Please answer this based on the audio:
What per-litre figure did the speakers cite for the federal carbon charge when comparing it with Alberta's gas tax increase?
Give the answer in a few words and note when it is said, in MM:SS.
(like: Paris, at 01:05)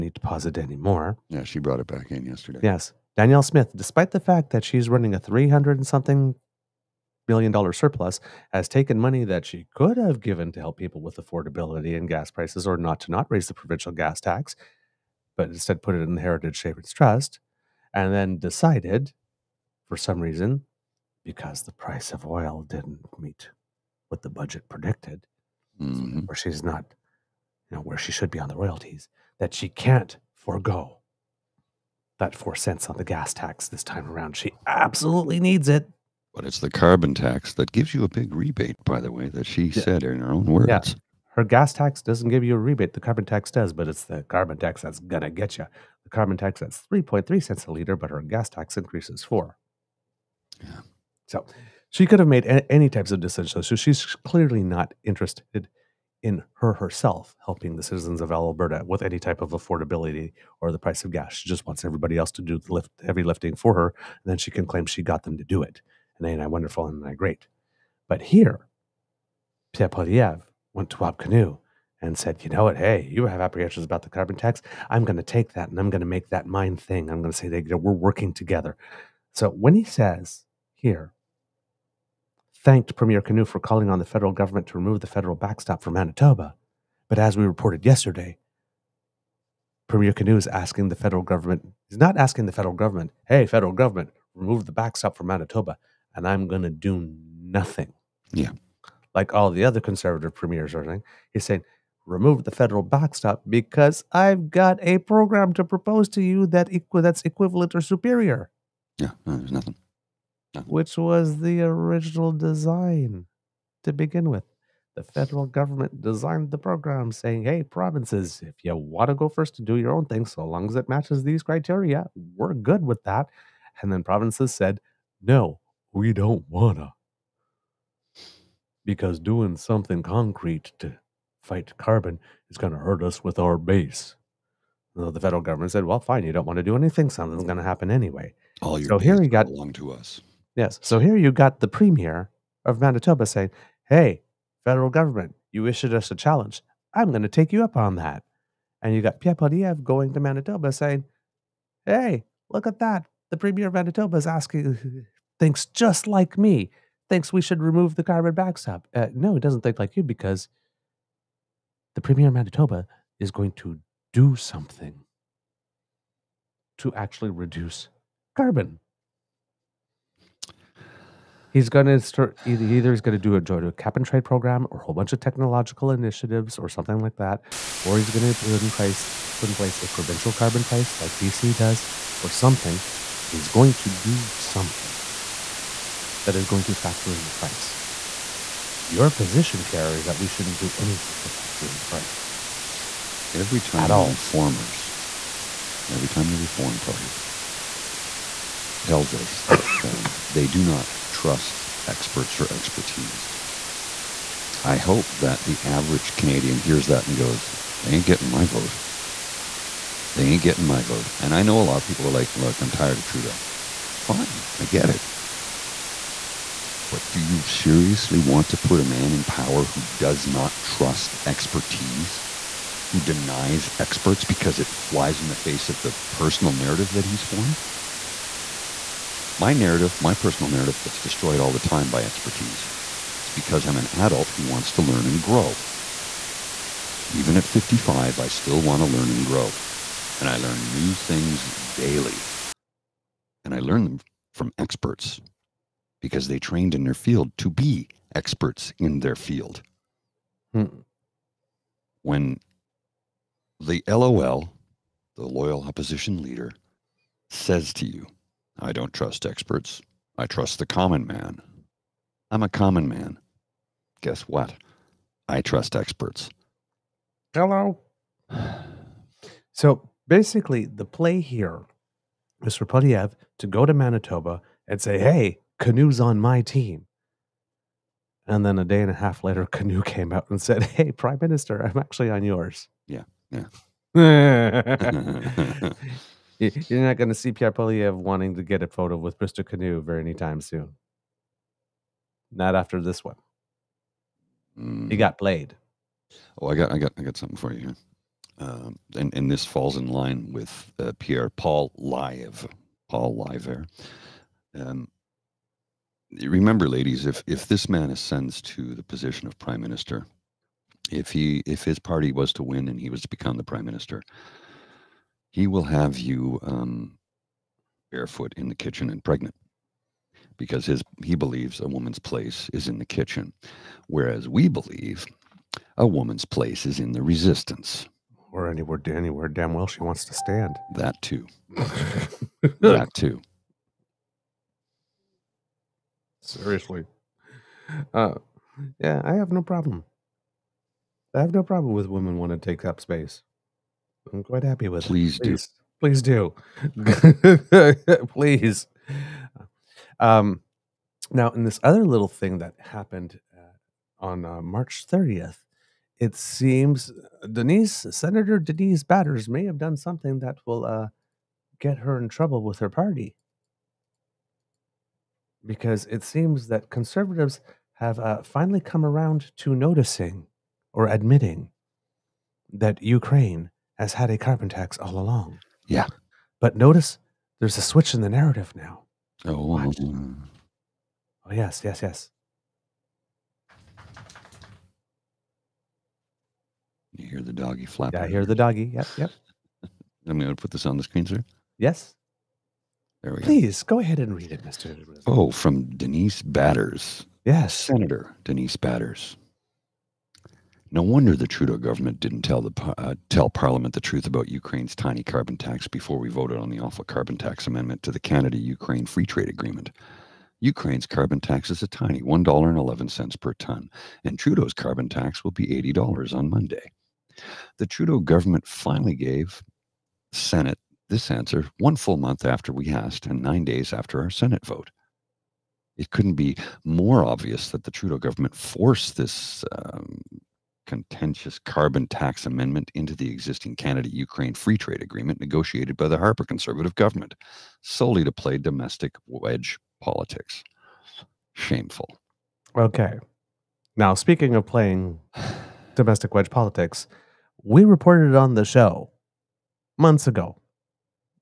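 3.3 cents, at 00:46.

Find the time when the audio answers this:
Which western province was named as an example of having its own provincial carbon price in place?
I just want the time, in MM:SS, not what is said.
03:01.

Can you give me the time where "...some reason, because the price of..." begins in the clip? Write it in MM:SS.
00:19.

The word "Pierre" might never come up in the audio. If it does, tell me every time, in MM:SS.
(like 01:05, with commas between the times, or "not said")
01:09, 02:29, 03:09, 04:47, 05:00.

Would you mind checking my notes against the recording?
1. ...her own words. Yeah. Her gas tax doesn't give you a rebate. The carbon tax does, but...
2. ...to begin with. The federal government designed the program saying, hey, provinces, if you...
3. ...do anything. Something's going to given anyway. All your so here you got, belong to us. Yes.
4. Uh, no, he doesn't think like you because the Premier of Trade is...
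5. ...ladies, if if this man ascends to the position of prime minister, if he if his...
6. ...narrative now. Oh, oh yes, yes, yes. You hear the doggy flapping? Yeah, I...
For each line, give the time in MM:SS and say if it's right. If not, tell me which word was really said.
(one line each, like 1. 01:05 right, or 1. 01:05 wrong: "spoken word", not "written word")
1. 00:40 right
2. 01:53 right
3. 02:16 wrong: "happen", not "given"
4. 02:38 wrong: "Manitoba", not "Trade"
5. 05:06 right
6. 06:18 right.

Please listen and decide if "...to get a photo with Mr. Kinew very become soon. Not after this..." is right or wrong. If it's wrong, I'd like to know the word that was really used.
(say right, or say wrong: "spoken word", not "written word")
wrong: "anytime", not "become".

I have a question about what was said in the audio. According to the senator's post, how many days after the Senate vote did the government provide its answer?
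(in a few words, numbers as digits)
9.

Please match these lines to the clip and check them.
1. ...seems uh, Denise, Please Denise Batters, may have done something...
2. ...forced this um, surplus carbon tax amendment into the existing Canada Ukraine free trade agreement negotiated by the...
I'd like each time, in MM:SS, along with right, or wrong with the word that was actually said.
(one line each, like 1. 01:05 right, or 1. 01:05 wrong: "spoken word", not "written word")
1. 05:56 wrong: "Senator", not "Please"
2. 07:08 wrong: "contentious", not "surplus".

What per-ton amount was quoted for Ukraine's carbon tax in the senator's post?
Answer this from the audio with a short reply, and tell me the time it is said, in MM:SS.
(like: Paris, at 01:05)
$1.11, at 06:52.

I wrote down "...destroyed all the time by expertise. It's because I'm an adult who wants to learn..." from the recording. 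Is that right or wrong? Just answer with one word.
right.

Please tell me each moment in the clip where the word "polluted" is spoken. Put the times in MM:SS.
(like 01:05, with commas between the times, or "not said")
not said.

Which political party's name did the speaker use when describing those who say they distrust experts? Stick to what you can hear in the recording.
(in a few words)
Reform Party.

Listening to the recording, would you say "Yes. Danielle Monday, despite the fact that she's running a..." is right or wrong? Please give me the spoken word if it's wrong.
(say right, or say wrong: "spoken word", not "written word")
wrong: "Smith", not "Monday".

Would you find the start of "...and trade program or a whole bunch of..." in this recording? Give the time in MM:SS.
02:53.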